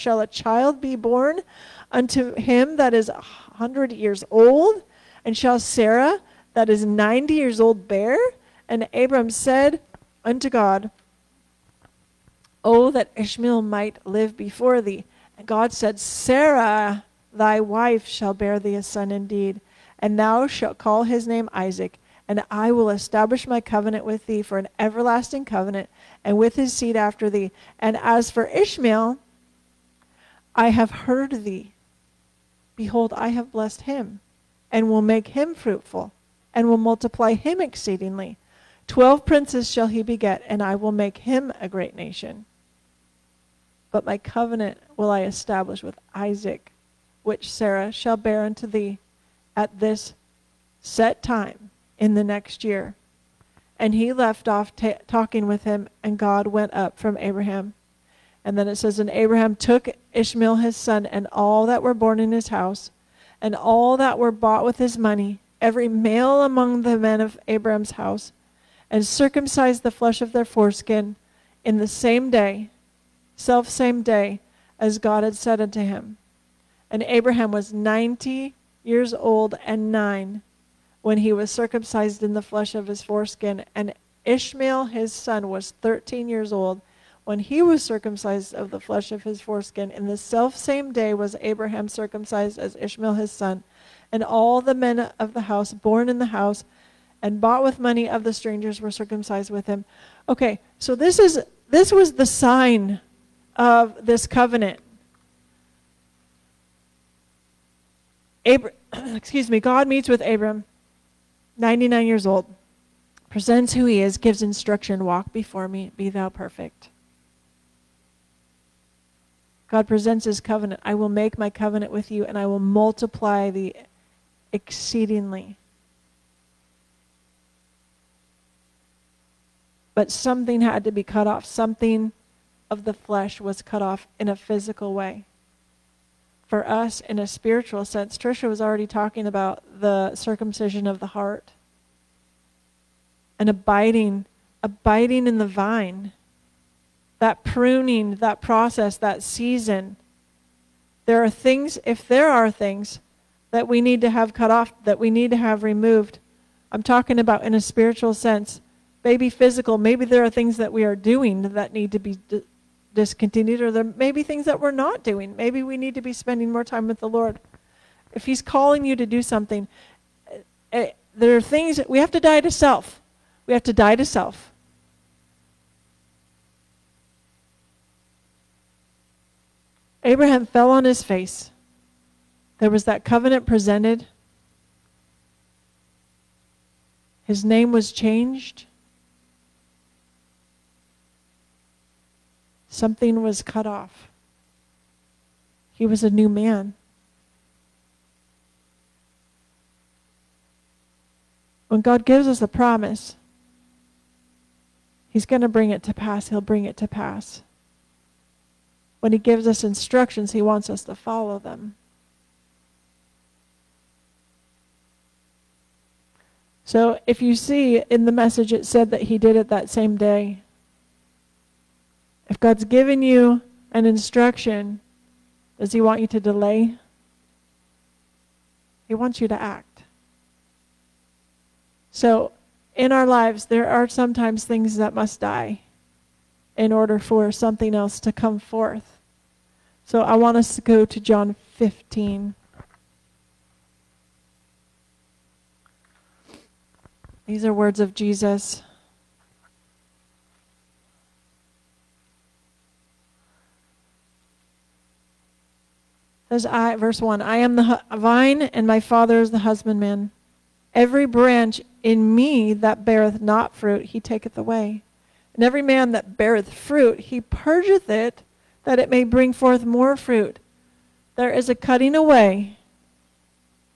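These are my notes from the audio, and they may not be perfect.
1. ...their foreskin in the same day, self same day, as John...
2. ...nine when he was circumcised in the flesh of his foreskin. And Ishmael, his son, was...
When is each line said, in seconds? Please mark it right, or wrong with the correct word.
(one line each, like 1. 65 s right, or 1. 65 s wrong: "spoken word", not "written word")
1. 70 s wrong: "God", not "John"
2. 79 s right.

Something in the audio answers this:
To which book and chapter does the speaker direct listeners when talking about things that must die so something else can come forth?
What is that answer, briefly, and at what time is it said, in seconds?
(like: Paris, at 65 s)
John 15, at 241 s.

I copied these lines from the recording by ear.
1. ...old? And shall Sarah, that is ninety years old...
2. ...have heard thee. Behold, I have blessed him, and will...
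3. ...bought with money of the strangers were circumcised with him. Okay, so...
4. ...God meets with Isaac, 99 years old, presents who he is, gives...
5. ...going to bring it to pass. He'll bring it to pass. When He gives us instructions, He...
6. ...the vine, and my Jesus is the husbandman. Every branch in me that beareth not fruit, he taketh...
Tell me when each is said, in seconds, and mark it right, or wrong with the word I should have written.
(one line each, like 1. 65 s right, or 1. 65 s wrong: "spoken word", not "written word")
1. 4 s right
2. 30 s right
3. 97 s right
4. 109 s wrong: "Abram", not "Isaac"
5. 205 s right
6. 257 s wrong: "Father", not "Jesus".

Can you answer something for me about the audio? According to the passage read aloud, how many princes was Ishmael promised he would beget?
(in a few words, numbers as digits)
12.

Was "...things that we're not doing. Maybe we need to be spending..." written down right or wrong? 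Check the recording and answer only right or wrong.
right.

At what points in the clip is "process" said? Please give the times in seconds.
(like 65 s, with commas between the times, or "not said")
148 s.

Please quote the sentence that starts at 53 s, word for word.
And he left off talking with him, and God went up from Abraham.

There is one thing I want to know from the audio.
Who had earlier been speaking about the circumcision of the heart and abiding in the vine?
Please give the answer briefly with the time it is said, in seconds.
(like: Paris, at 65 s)
Trisha, at 138 s.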